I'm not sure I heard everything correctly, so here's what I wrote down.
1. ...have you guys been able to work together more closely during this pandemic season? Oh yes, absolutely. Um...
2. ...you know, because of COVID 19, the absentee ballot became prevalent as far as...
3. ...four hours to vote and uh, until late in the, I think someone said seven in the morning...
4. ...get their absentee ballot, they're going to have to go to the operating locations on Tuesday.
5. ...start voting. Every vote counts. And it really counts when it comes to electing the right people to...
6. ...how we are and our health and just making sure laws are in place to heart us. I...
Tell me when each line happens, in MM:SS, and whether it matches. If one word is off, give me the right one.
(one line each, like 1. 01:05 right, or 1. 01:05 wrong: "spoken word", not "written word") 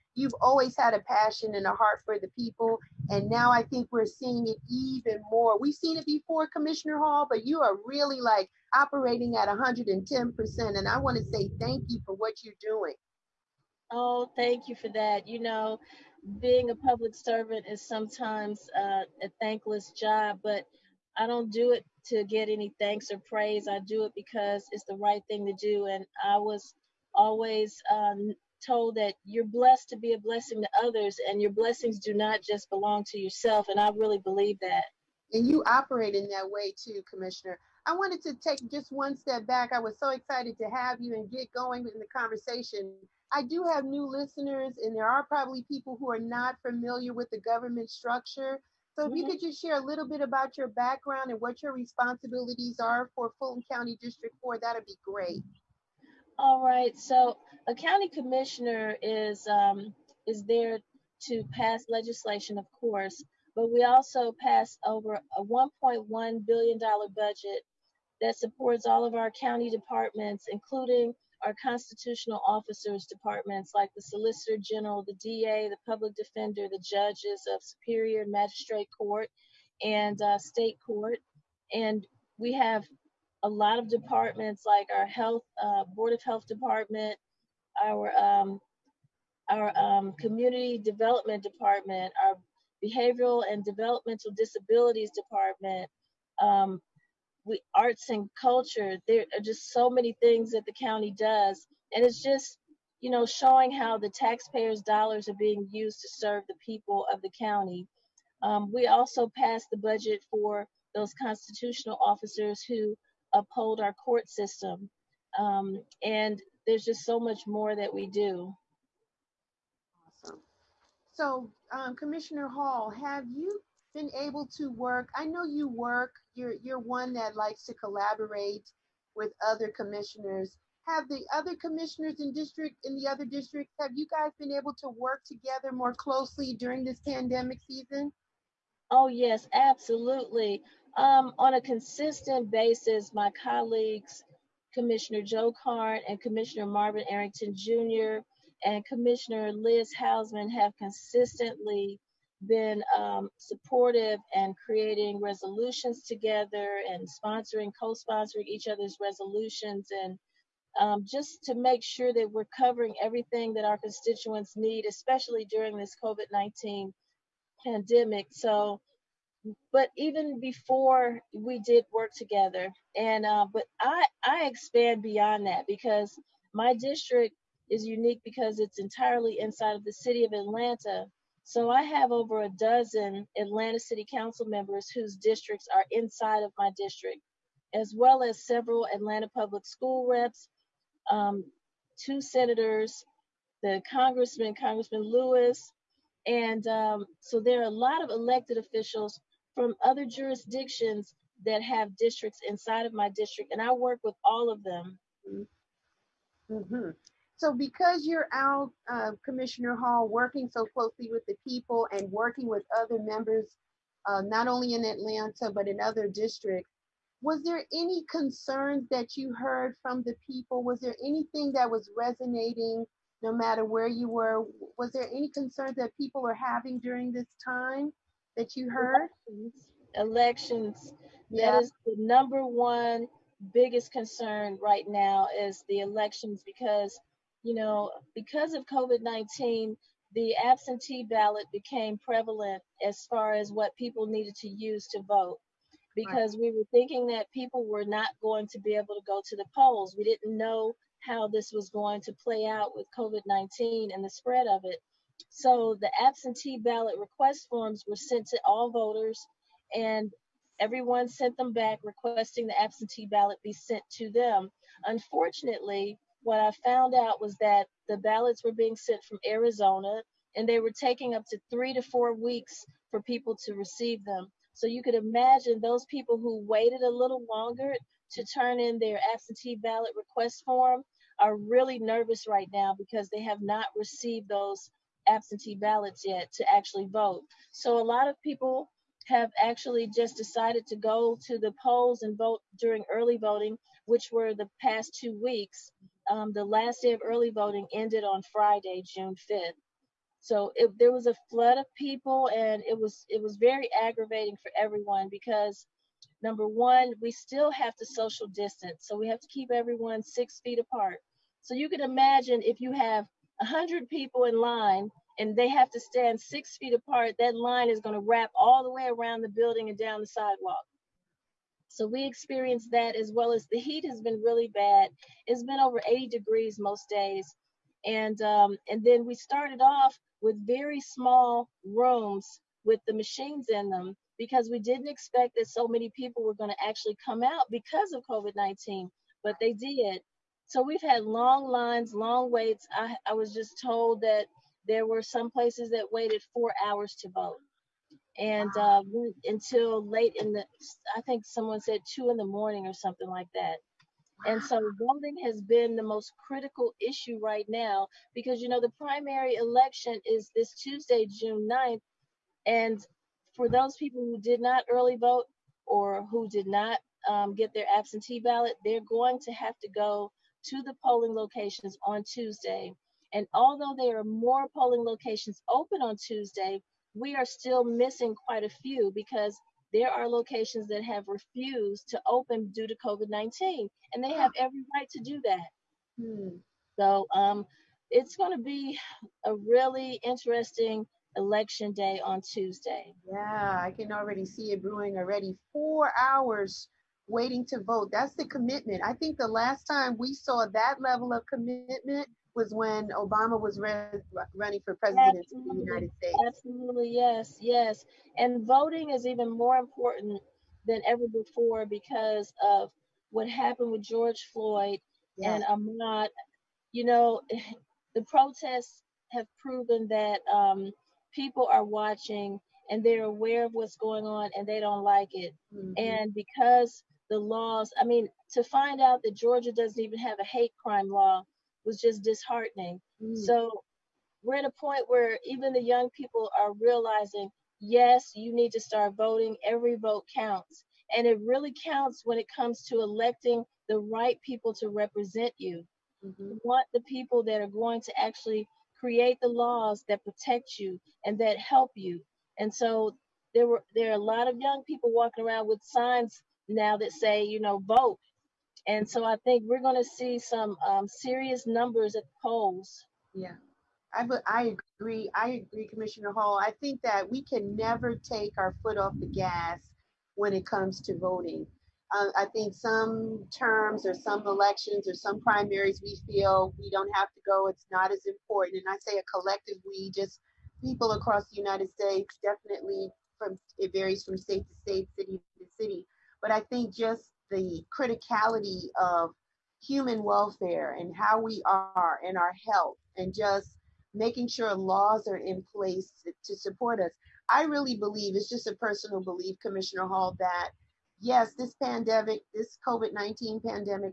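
1. 02:13 right
2. 03:57 right
3. 05:46 wrong: "two", not "seven"
4. 06:07 wrong: "polling", not "operating"
5. 07:18 right
6. 08:10 wrong: "support", not "heart".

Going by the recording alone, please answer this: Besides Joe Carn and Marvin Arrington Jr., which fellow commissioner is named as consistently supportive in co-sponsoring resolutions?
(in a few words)
Liz Hausmann.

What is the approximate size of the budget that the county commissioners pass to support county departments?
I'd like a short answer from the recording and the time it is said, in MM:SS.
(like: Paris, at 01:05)
$1.1 billion, at 01:05.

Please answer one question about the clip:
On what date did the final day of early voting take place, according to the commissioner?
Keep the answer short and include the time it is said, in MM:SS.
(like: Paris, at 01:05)
June 5, at 04:58.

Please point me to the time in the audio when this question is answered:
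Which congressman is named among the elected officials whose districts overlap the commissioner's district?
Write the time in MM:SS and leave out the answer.
03:14.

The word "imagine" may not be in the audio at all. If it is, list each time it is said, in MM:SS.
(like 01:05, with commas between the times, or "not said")
04:34, 05:11.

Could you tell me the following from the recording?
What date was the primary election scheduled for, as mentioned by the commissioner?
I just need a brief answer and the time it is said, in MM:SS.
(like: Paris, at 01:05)
June 9, at 06:01.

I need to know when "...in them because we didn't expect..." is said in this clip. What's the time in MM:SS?
05:33.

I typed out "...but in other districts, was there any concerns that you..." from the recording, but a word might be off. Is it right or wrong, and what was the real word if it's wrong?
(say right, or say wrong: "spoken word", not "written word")
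right.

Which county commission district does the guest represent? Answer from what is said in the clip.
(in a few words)
District 4.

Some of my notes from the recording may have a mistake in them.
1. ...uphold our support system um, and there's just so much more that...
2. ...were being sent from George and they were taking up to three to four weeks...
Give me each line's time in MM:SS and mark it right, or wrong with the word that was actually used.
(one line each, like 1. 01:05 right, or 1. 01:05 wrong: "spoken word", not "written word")
1. 01:53 wrong: "court", not "support"
2. 04:28 wrong: "Arizona", not "George".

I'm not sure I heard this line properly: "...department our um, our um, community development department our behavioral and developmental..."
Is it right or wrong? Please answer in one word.
right.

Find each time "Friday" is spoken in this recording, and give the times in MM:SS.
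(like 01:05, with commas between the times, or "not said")
04:58.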